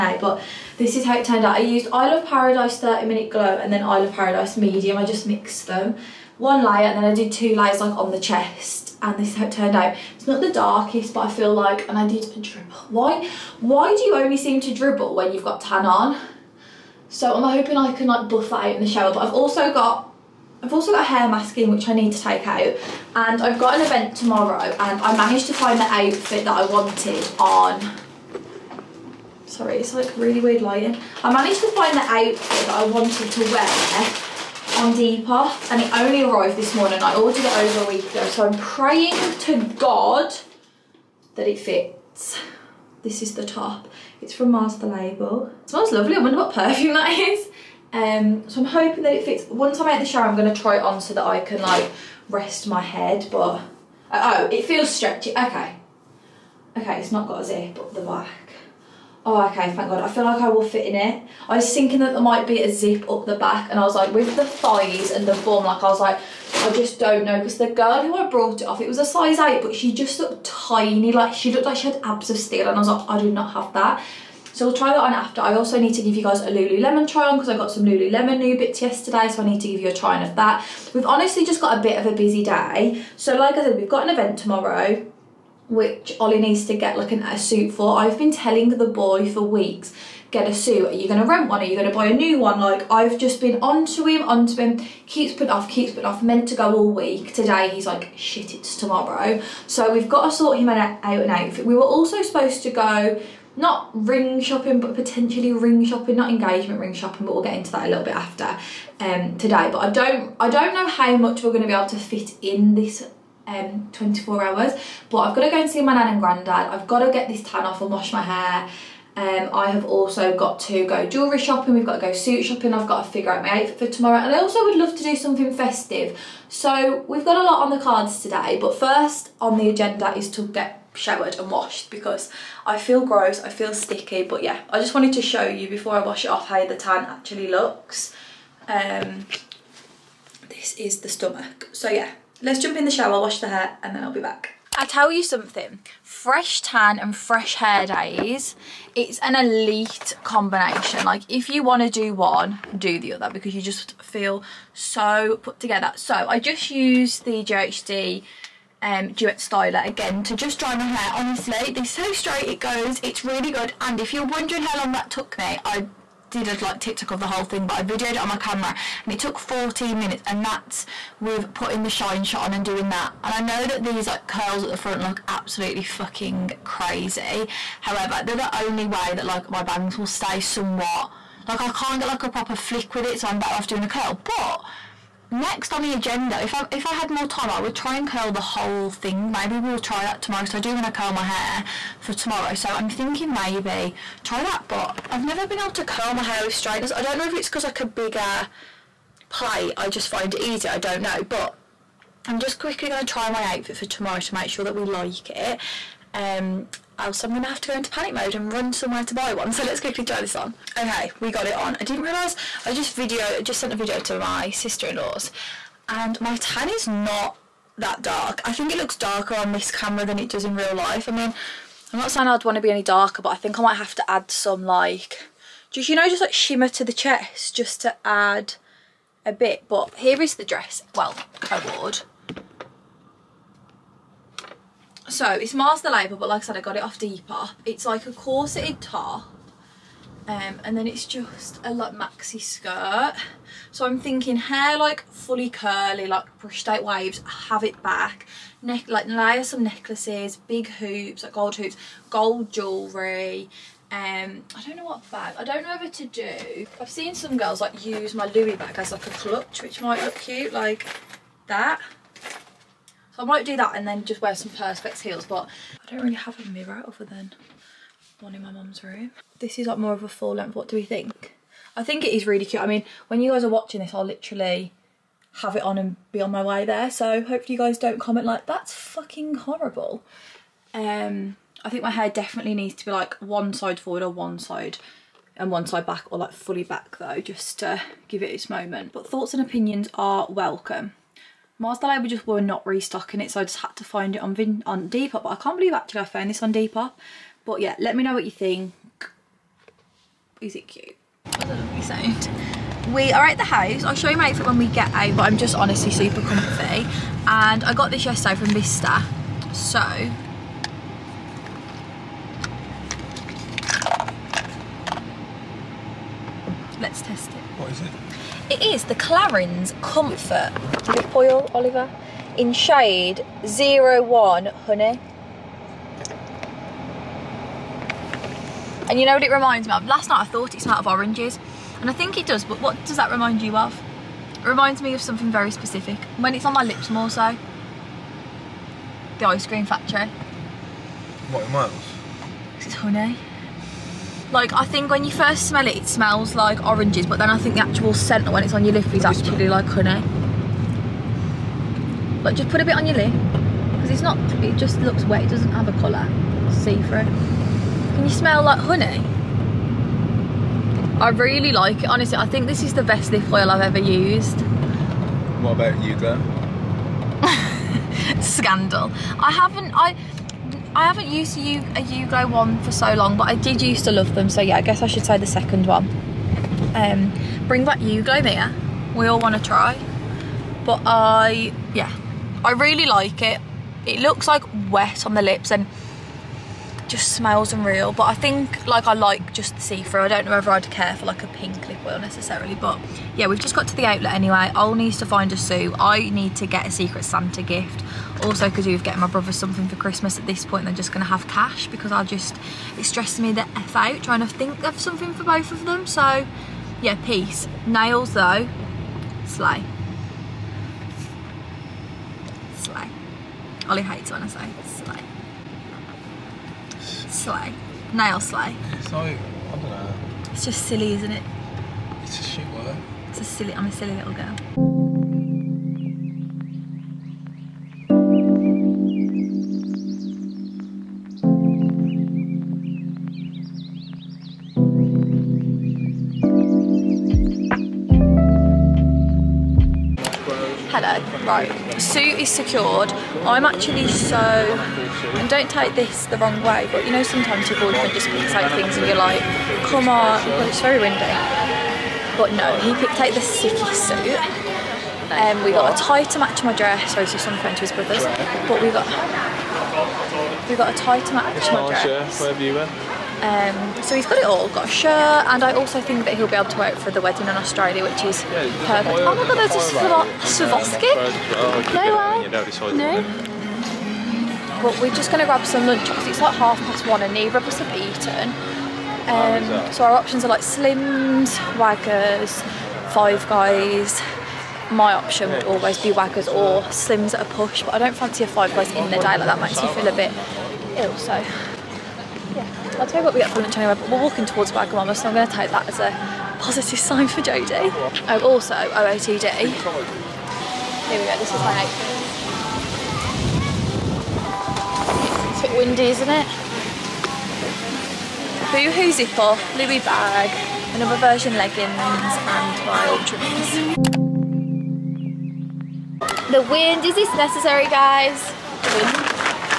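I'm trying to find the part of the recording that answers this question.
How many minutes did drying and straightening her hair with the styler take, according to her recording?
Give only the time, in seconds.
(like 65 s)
169 s.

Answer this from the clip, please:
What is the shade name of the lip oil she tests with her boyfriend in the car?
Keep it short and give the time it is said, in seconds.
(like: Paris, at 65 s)
01 Honey, at 323 s.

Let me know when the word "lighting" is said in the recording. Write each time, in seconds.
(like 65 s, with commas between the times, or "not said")
30 s.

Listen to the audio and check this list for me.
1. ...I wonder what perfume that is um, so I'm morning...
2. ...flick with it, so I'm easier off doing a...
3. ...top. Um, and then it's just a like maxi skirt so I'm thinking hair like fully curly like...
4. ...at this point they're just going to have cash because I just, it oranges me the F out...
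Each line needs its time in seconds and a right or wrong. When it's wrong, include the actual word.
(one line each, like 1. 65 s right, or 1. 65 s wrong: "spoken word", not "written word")
1. 46 s wrong: "hoping", not "morning"
2. 182 s wrong: "better", not "easier"
3. 238 s right
4. 400 s wrong: "stresses", not "oranges".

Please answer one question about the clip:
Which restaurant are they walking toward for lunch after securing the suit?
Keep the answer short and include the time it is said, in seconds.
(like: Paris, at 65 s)
Wagamama, at 494 s.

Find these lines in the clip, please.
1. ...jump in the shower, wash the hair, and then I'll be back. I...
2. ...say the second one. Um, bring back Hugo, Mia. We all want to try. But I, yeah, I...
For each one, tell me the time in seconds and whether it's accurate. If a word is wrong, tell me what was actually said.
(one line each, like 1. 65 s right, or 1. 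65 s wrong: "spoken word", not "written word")
1. 142 s right
2. 375 s right.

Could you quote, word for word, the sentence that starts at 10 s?
It's not the darkest, but I feel like, and I did a dribble.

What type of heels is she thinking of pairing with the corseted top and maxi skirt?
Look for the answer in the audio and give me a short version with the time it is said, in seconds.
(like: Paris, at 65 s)
Perspex heels, at 264 s.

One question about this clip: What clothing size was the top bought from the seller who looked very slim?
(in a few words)
8.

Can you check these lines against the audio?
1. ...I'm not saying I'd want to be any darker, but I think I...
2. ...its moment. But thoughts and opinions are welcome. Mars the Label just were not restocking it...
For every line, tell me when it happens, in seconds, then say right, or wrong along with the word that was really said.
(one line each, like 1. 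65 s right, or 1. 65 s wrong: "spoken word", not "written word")
1. 221 s right
2. 288 s right.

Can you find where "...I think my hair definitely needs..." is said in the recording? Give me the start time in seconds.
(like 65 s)
281 s.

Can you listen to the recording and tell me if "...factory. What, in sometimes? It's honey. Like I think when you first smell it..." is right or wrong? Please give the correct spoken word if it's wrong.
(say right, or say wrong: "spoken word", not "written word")
wrong: "miles", not "sometimes".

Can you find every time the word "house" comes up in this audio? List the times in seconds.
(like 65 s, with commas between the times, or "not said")
303 s.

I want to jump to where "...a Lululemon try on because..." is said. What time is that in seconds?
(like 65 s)
76 s.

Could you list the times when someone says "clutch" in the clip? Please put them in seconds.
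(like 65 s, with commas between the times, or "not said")
259 s.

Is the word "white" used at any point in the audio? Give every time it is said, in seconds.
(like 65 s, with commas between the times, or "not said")
not said.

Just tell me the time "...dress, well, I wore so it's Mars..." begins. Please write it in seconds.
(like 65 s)
230 s.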